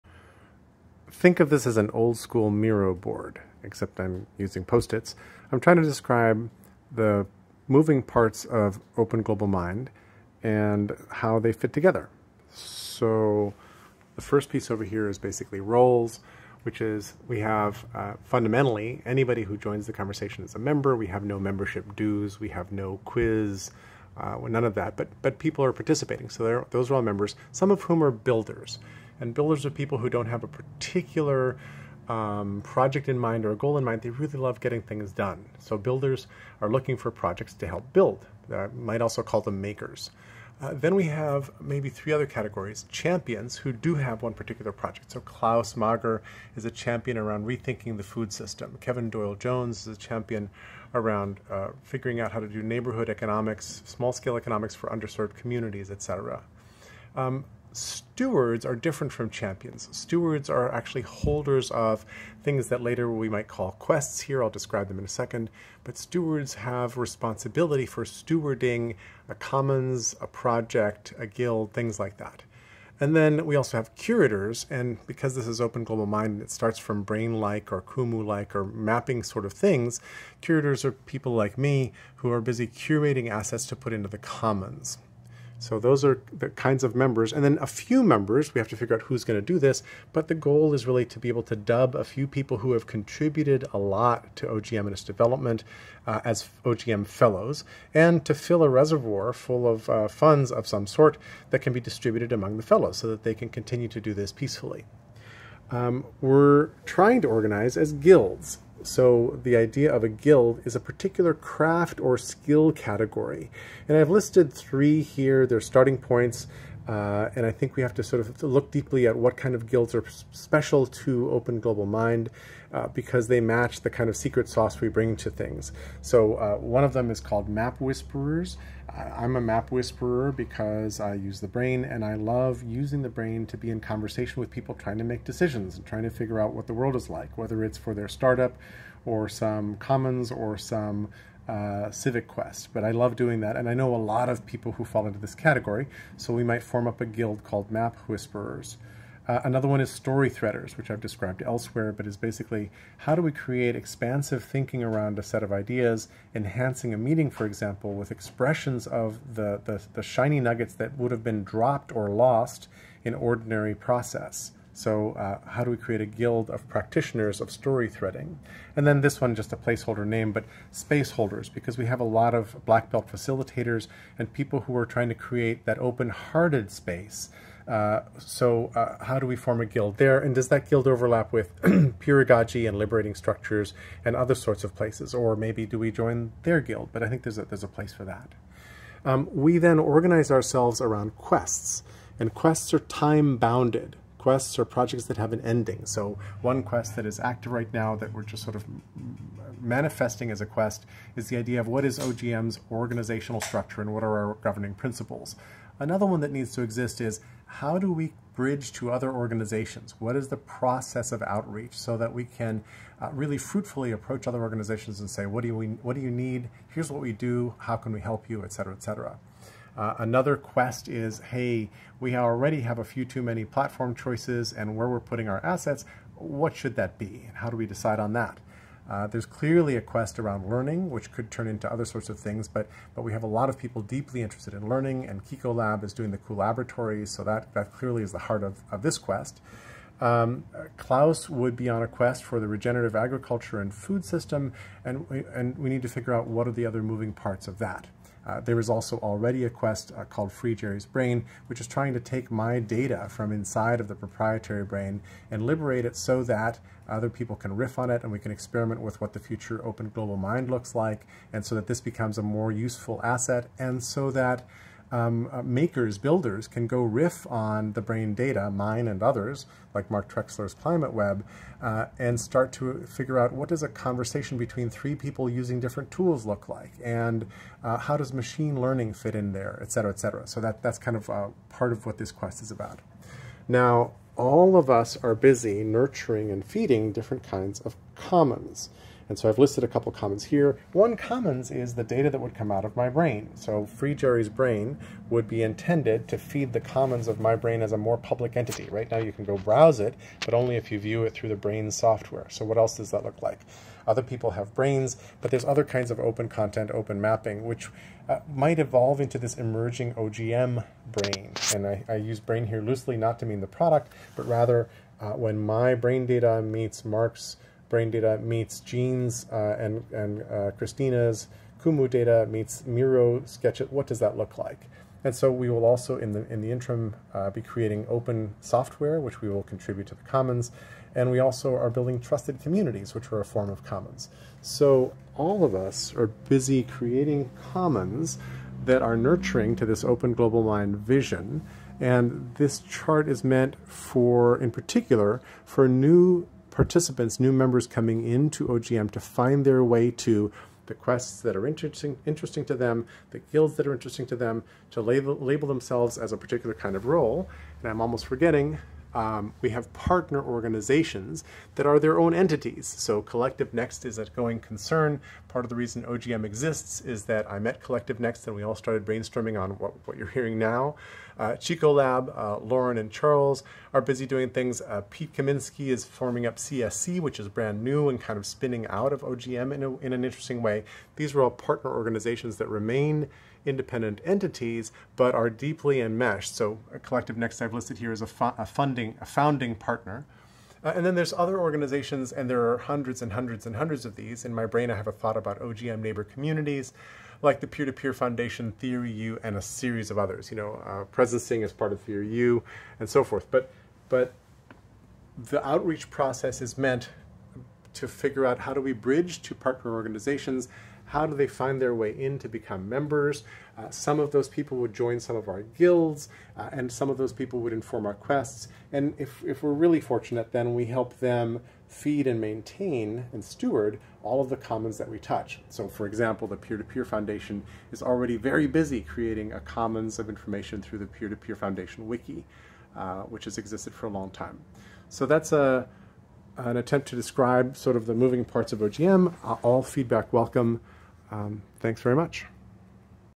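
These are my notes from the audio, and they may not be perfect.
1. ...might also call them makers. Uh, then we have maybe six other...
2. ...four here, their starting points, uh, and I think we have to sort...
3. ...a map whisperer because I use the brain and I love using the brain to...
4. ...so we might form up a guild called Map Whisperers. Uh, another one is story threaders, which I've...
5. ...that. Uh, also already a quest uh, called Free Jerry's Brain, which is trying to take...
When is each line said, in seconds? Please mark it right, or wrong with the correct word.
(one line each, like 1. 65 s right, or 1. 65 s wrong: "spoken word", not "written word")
1. 38 s wrong: "three", not "six"
2. 114 s wrong: "three", not "four"
3. 129 s right
4. 146 s right
5. 247 s right.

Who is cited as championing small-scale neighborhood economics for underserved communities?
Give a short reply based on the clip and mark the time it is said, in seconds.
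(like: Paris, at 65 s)
Kevin Doyle Jones, at 48 s.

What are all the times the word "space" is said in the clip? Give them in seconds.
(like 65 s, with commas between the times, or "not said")
170 s, 176 s.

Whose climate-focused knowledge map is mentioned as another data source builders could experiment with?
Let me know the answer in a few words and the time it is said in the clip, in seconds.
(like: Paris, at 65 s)
Mark Trexler, at 269 s.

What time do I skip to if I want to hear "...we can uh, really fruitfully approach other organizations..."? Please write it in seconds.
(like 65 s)
212 s.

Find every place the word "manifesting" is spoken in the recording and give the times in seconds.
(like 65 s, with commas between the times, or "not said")
199 s.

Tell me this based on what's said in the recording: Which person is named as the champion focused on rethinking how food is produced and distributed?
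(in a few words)
Klaus Mager.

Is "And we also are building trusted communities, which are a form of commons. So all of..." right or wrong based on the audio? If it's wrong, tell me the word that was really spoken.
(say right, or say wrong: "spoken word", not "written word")
right.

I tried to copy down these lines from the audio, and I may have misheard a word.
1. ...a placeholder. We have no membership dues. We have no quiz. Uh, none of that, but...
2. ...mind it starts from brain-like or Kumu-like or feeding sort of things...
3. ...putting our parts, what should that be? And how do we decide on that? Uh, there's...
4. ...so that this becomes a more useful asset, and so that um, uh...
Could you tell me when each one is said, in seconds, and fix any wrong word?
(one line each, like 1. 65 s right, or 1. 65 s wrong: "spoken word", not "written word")
1. 20 s wrong: "member", not "placeholder"
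2. 76 s wrong: "mapping", not "feeding"
3. 224 s wrong: "assets", not "parts"
4. 261 s right.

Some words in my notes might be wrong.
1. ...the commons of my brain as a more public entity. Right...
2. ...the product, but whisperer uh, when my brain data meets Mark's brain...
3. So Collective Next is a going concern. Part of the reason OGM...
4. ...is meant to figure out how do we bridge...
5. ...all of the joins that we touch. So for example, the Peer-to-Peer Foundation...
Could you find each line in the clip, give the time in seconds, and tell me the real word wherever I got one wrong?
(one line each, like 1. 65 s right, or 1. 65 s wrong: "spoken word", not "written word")
1. 296 s right
2. 313 s wrong: "rather", not "whisperer"
3. 362 s right
4. 406 s right
5. 424 s wrong: "commons", not "joins".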